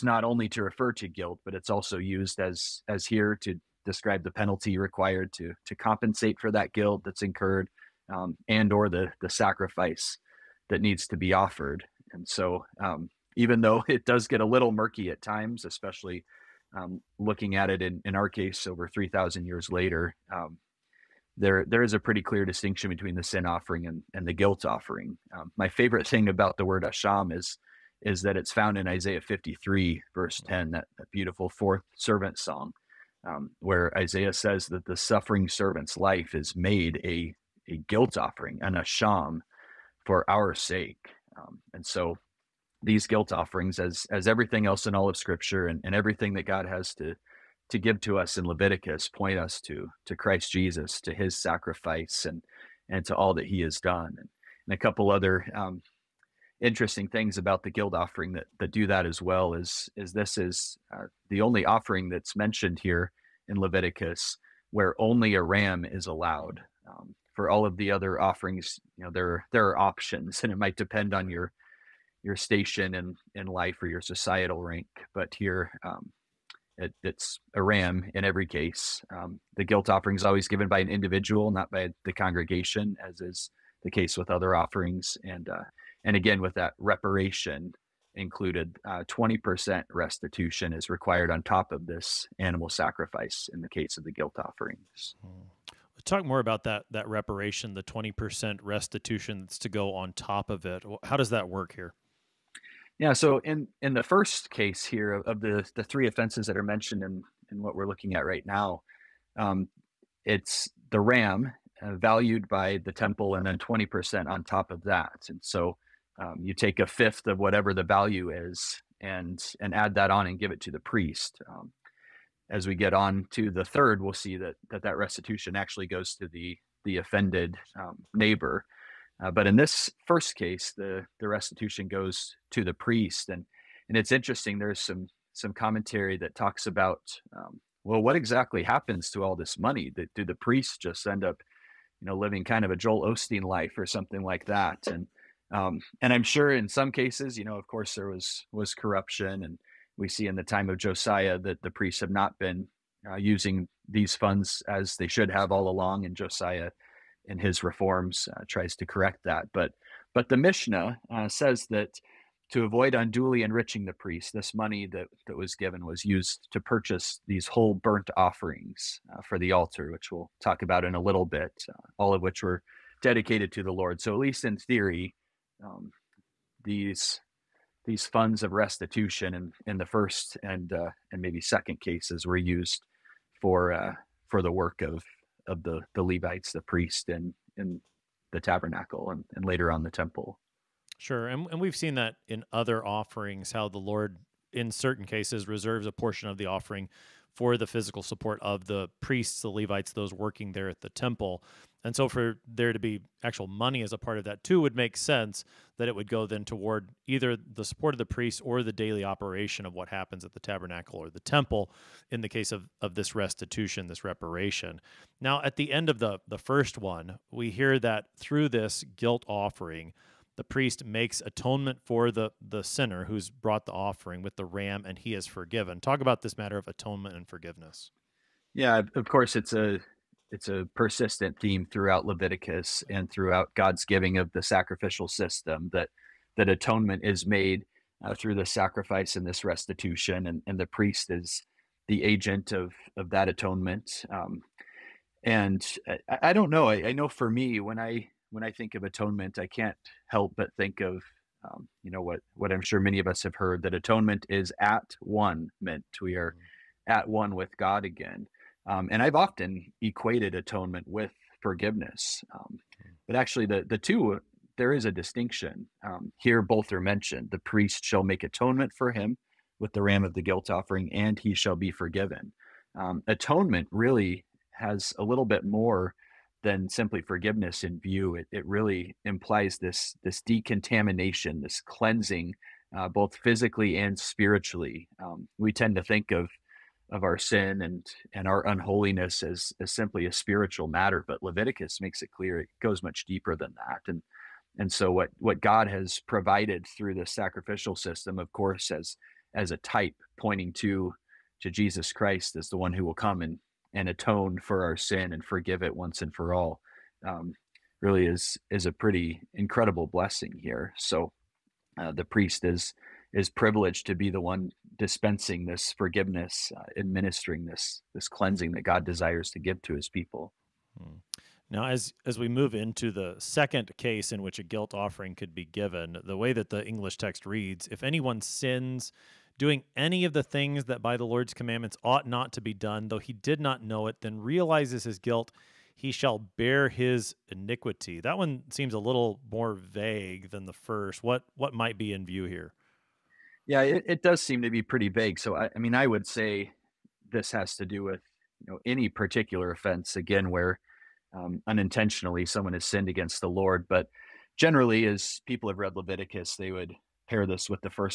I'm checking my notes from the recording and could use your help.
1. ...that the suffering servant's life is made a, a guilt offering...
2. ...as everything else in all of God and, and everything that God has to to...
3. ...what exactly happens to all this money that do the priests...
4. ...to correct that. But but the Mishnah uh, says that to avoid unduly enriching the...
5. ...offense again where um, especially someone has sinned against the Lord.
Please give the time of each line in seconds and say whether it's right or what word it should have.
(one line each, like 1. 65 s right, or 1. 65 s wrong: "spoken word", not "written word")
1. 34 s right
2. 44 s wrong: "Scripture", not "God"
3. 138 s right
4. 158 s right
5. 349 s wrong: "unintentionally", not "especially".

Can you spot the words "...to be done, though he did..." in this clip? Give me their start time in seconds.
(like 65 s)
332 s.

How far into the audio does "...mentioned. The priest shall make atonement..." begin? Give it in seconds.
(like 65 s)
266 s.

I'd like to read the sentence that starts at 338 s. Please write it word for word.
That one seems a little more vague than the first.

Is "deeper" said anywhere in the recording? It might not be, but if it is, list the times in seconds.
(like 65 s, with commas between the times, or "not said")
293 s.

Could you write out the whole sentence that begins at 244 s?
Um, and I, I, don't know.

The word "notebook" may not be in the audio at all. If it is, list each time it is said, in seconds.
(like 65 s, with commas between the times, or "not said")
not said.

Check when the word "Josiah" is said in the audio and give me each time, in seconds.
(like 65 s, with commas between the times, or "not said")
150 s, 156 s.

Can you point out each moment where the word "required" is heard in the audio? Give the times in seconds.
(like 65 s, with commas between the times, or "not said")
4 s, 90 s.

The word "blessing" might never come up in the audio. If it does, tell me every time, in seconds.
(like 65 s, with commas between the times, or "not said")
309 s.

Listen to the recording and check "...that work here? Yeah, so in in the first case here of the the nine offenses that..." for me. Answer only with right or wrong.
wrong.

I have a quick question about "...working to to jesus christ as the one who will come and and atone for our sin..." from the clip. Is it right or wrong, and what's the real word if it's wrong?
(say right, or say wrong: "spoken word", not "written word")
wrong: "pointing", not "working".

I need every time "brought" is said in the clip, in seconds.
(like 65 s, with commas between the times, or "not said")
223 s.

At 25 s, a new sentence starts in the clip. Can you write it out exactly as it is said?
Um, my favorite thing about the word asham is is that it's found in Isaiah 53 verse mm.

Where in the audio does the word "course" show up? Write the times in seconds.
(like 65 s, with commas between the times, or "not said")
147 s, 229 s, 298 s.